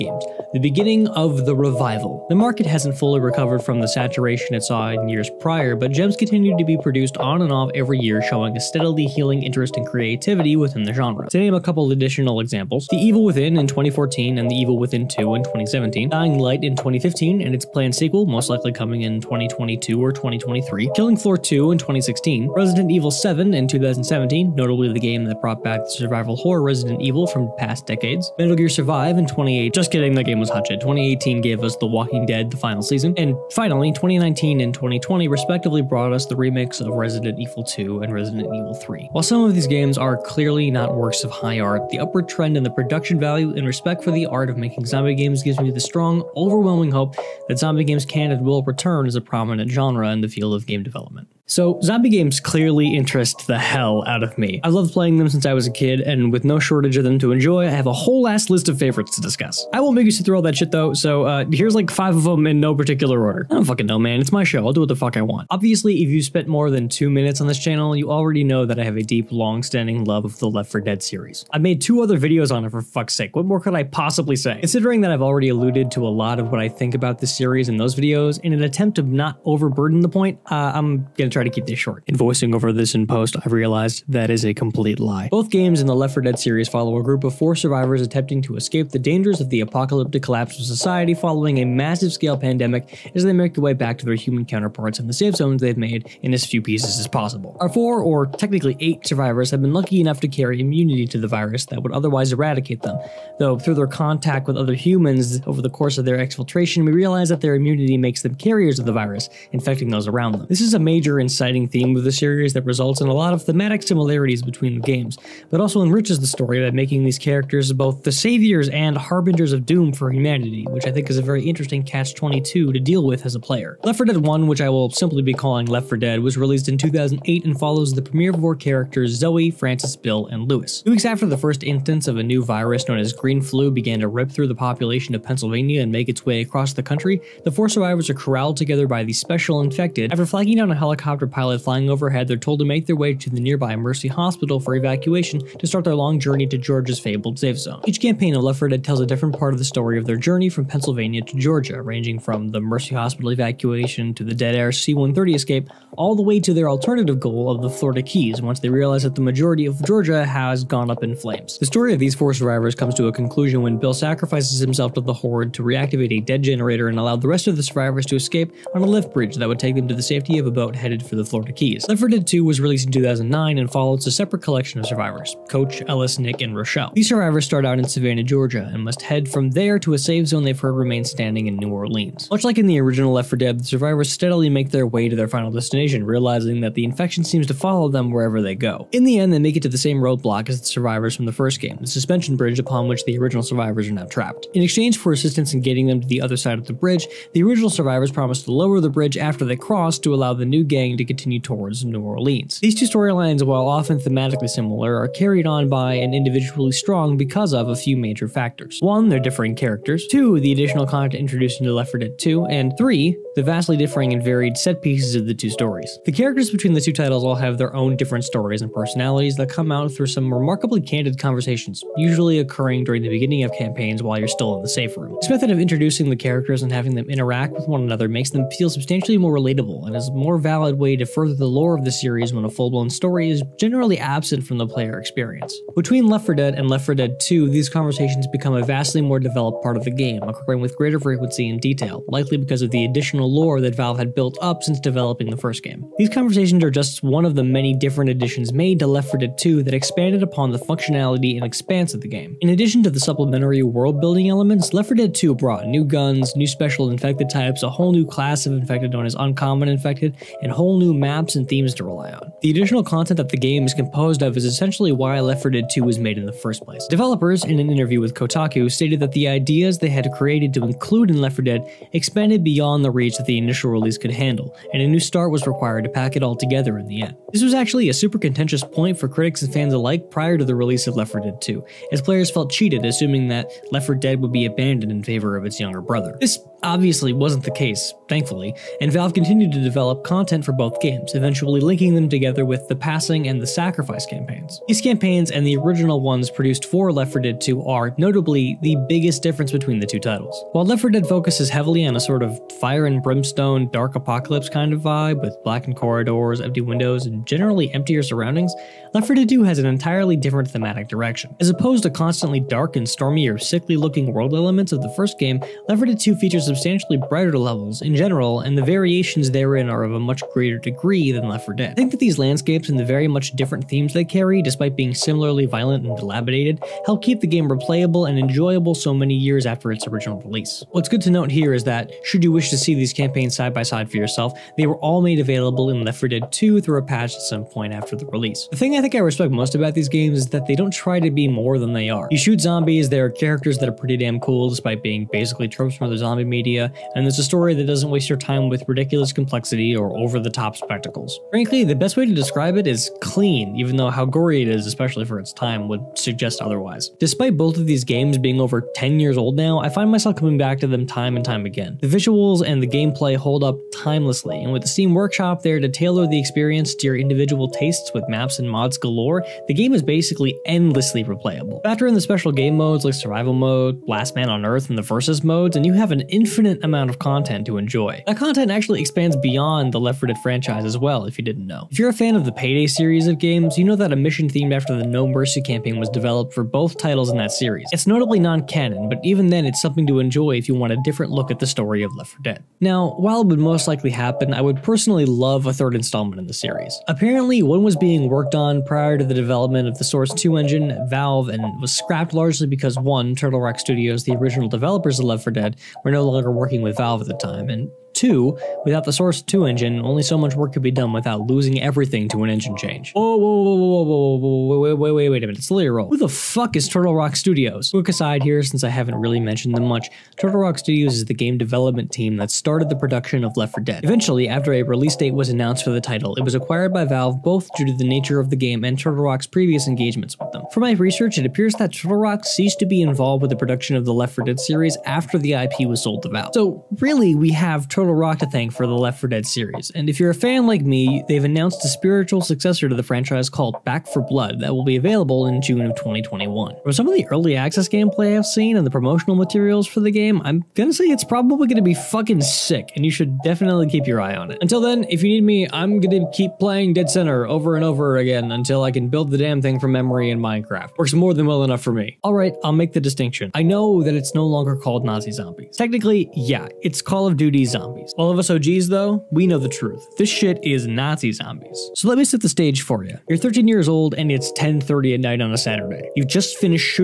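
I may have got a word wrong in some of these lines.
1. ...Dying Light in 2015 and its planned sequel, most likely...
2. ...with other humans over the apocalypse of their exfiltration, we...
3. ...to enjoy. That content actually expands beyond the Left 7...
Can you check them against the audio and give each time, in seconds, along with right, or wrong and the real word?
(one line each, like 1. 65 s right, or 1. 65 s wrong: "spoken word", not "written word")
1. 16 s right
2. 104 s wrong: "course", not "apocalypse"
3. 377 s wrong: "4", not "7".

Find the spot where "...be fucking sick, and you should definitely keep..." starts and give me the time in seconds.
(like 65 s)
451 s.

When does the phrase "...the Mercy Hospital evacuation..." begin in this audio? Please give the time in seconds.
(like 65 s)
152 s.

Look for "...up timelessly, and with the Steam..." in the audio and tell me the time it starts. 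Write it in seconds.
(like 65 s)
363 s.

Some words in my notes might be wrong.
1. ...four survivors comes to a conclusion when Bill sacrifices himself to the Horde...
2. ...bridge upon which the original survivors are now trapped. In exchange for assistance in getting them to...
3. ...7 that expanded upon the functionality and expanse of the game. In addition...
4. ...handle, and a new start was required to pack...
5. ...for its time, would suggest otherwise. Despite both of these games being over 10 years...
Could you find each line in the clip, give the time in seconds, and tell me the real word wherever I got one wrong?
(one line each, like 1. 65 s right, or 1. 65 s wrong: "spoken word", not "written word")
1. 162 s right
2. 192 s right
3. 249 s wrong: "2", not "7"
4. 274 s right
5. 355 s right.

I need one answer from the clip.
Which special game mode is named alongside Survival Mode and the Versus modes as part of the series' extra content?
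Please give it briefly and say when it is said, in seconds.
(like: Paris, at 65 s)
Last Man on Earth, at 373 s.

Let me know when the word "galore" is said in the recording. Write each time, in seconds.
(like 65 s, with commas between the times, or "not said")
368 s.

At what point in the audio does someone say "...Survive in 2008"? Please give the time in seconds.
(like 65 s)
28 s.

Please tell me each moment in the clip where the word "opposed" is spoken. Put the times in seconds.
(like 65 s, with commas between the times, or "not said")
311 s.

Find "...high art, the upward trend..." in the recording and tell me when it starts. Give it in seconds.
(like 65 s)
41 s.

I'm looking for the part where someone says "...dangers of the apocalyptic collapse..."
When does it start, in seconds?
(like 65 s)
88 s.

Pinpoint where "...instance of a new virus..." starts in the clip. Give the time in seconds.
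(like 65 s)
131 s.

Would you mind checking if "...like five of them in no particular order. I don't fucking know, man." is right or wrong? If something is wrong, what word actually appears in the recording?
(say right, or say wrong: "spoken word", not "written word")
right.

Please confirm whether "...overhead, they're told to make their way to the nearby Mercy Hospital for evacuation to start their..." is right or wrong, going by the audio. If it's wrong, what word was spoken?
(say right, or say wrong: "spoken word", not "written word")
right.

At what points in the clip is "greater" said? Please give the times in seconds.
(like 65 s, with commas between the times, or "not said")
240 s, 320 s.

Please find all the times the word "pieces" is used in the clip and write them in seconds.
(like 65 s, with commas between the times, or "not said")
96 s, 214 s.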